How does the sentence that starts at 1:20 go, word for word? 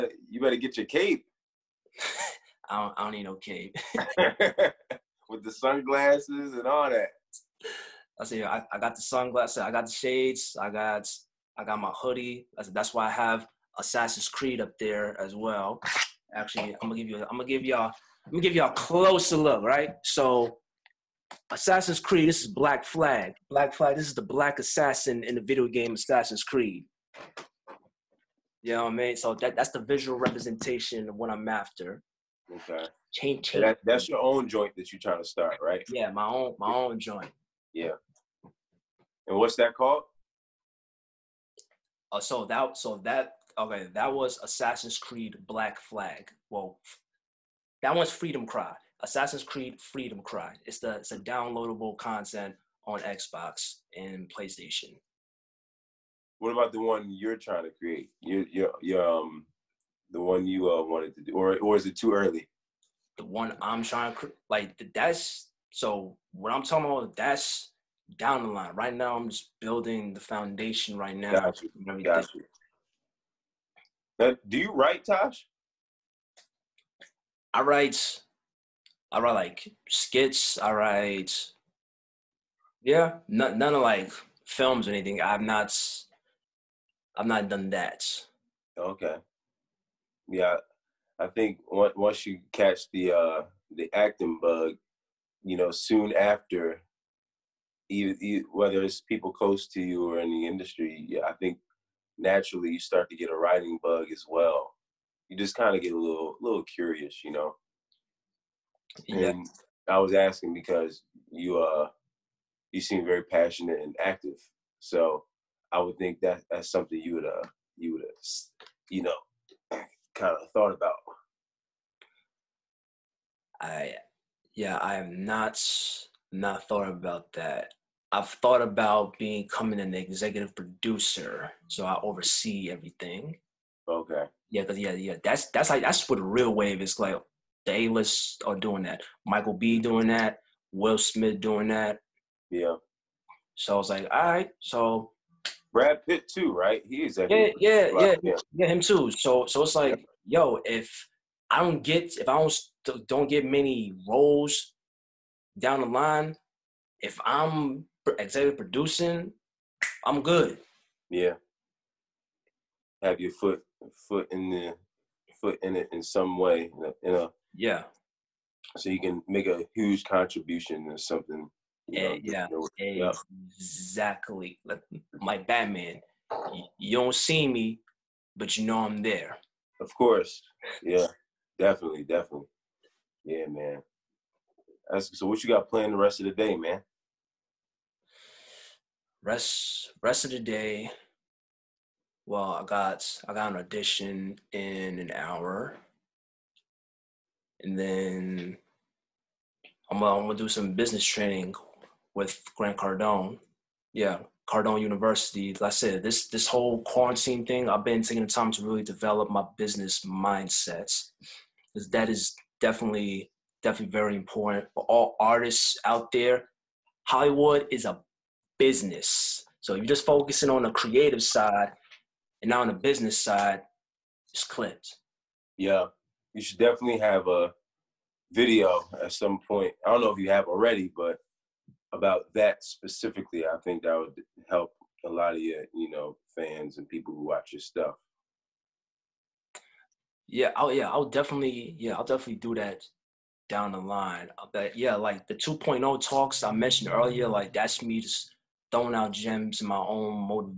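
I write, yeah, none, none of like films or anything.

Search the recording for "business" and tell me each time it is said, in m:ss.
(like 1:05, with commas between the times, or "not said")
3:20, 3:29, 3:38, 3:42.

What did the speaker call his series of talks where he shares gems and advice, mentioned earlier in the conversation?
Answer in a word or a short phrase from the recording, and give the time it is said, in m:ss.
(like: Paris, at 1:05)
2.0 talks, at 4:05.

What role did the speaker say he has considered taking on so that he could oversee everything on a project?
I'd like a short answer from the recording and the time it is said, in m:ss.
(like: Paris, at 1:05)
Executive producer, at 2:09.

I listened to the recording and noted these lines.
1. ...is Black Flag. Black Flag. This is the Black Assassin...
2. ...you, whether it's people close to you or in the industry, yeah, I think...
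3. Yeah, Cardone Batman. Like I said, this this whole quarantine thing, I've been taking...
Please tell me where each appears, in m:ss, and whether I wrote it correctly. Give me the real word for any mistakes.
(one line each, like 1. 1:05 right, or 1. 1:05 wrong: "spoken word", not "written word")
1. 0:22 right
2. 1:38 right
3. 3:23 wrong: "University", not "Batman".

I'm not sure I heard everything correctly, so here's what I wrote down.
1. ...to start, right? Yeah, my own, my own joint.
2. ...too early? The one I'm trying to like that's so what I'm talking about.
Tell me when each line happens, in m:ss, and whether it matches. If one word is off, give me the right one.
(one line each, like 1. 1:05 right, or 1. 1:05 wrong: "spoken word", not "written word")
1. 0:35 right
2. 1:01 right.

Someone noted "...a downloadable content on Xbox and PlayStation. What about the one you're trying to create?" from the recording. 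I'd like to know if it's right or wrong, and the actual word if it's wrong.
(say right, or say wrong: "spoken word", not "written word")
right.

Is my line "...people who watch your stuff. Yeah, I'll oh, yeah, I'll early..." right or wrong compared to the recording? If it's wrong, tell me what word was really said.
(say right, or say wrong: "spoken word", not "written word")
wrong: "definitely", not "early".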